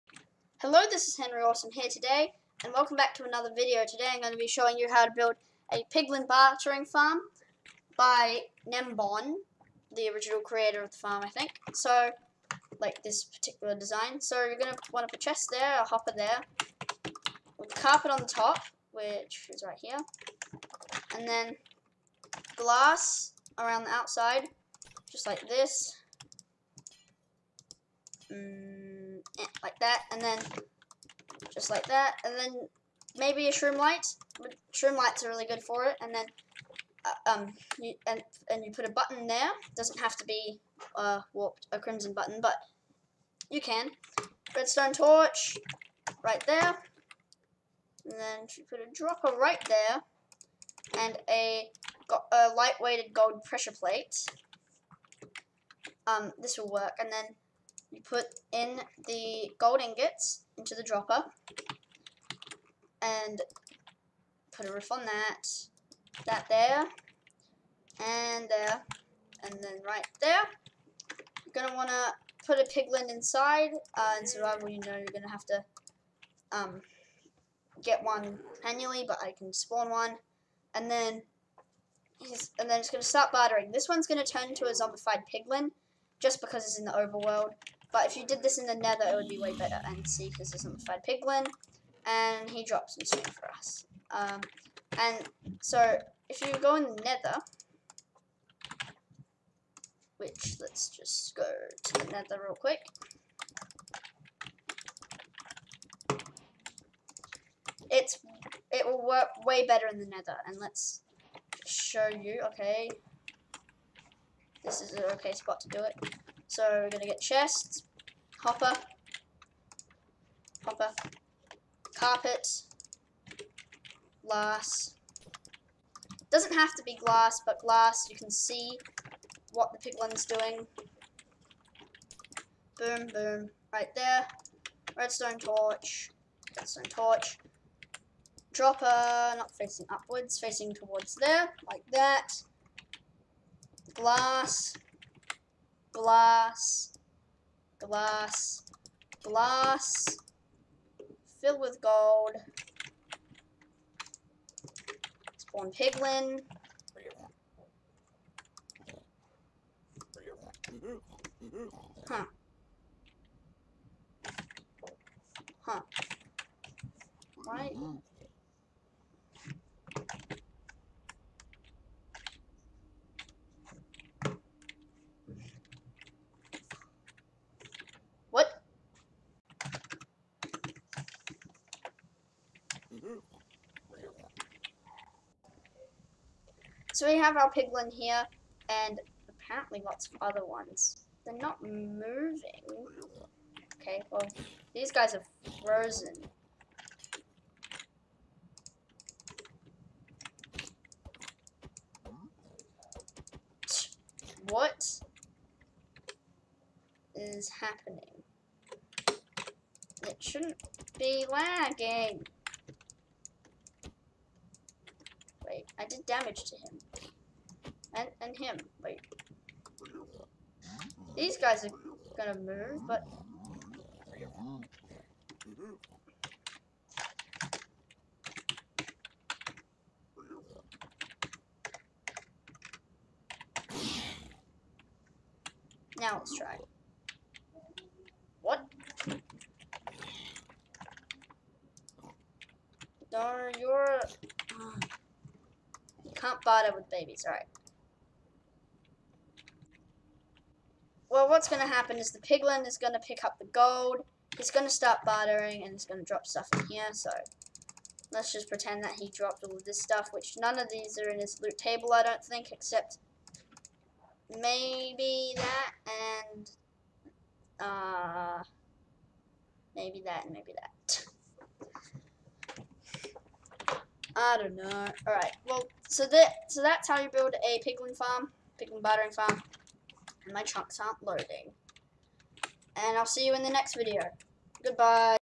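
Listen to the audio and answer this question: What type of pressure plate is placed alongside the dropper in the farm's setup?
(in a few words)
light weighted gold pressure plate.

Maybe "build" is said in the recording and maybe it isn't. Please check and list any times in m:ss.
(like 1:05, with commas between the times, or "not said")
0:05, 4:37.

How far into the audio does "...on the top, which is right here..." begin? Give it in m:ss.
0:18.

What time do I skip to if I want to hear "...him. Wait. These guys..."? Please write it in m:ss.
3:38.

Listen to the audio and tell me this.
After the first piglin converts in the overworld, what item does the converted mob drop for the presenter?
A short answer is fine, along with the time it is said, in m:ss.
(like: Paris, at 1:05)
stone, at 1:33.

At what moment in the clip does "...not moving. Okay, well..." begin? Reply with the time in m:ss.
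3:11.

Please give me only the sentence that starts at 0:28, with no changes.
Mm like that, and then just like that, and then maybe a Shroomlight.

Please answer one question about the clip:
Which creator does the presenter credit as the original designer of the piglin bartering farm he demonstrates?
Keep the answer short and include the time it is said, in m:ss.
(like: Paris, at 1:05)
Nembon, at 0:08.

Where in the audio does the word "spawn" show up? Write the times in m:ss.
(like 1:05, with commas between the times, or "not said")
1:19, 2:35.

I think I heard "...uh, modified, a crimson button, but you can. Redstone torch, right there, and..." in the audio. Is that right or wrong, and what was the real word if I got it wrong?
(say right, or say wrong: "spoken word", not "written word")
wrong: "warped", not "modified".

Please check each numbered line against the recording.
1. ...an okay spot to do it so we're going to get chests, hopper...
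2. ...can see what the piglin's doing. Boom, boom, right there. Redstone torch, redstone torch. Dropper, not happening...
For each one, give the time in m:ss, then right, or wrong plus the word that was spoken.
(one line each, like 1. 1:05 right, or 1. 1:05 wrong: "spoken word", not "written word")
1. 1:54 right
2. 2:08 wrong: "facing", not "happening".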